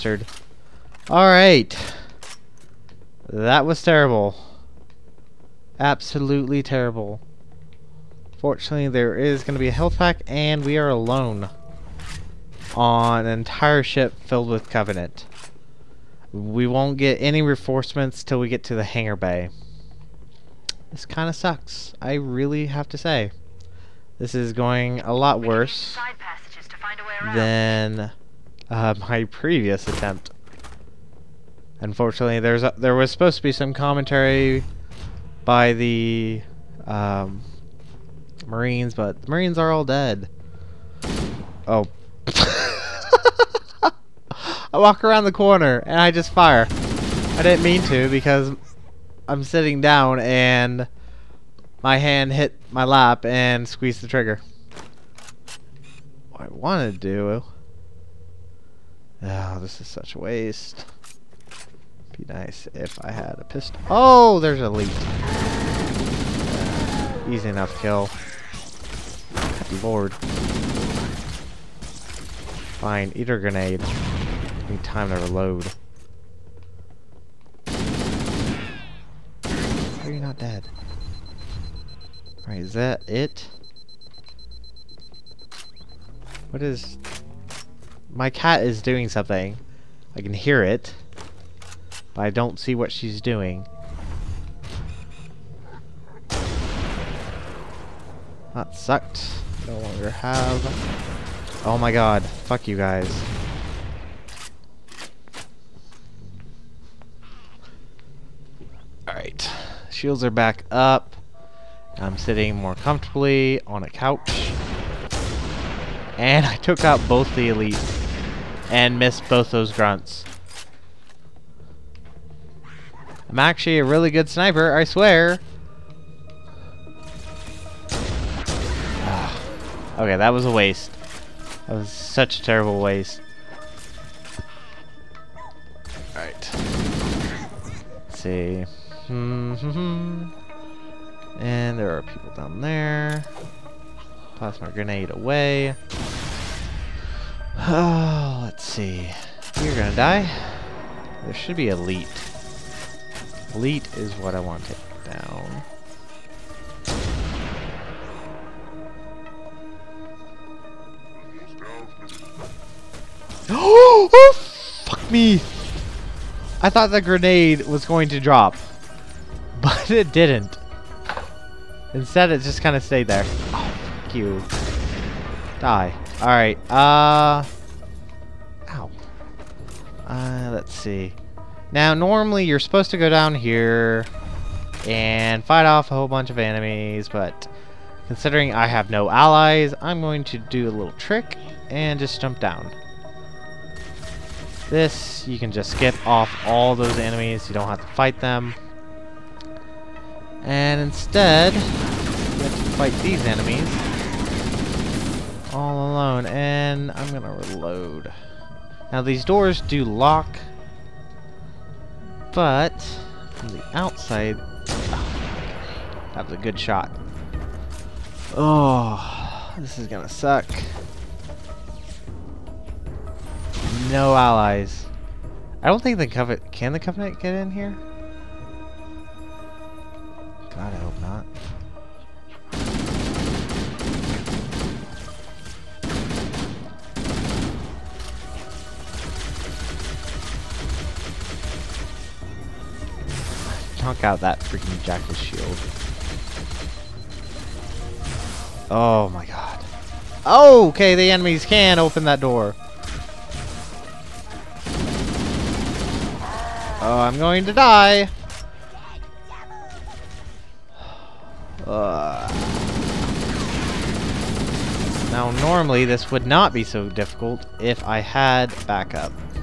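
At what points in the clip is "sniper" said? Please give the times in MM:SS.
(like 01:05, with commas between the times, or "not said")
02:04.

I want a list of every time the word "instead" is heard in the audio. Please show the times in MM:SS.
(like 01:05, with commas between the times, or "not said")
02:51, 03:20.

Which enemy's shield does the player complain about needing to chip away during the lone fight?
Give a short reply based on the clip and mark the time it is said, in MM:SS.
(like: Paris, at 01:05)
Jackal, at 04:04.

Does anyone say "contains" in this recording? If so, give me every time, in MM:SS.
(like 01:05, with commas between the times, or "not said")
not said.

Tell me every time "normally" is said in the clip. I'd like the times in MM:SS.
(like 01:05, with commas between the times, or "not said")
03:01, 04:25.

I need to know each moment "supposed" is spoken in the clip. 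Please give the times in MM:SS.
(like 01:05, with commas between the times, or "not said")
00:33, 03:02.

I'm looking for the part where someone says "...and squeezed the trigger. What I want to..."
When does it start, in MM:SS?
00:53.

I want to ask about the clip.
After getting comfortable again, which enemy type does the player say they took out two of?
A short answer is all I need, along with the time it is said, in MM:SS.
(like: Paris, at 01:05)
Elites, at 01:57.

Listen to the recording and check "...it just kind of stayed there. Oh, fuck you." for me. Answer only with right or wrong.
right.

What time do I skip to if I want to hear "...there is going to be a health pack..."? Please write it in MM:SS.
00:08.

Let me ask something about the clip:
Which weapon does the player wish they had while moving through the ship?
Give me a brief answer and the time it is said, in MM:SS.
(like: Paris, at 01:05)
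A pistol, at 01:03.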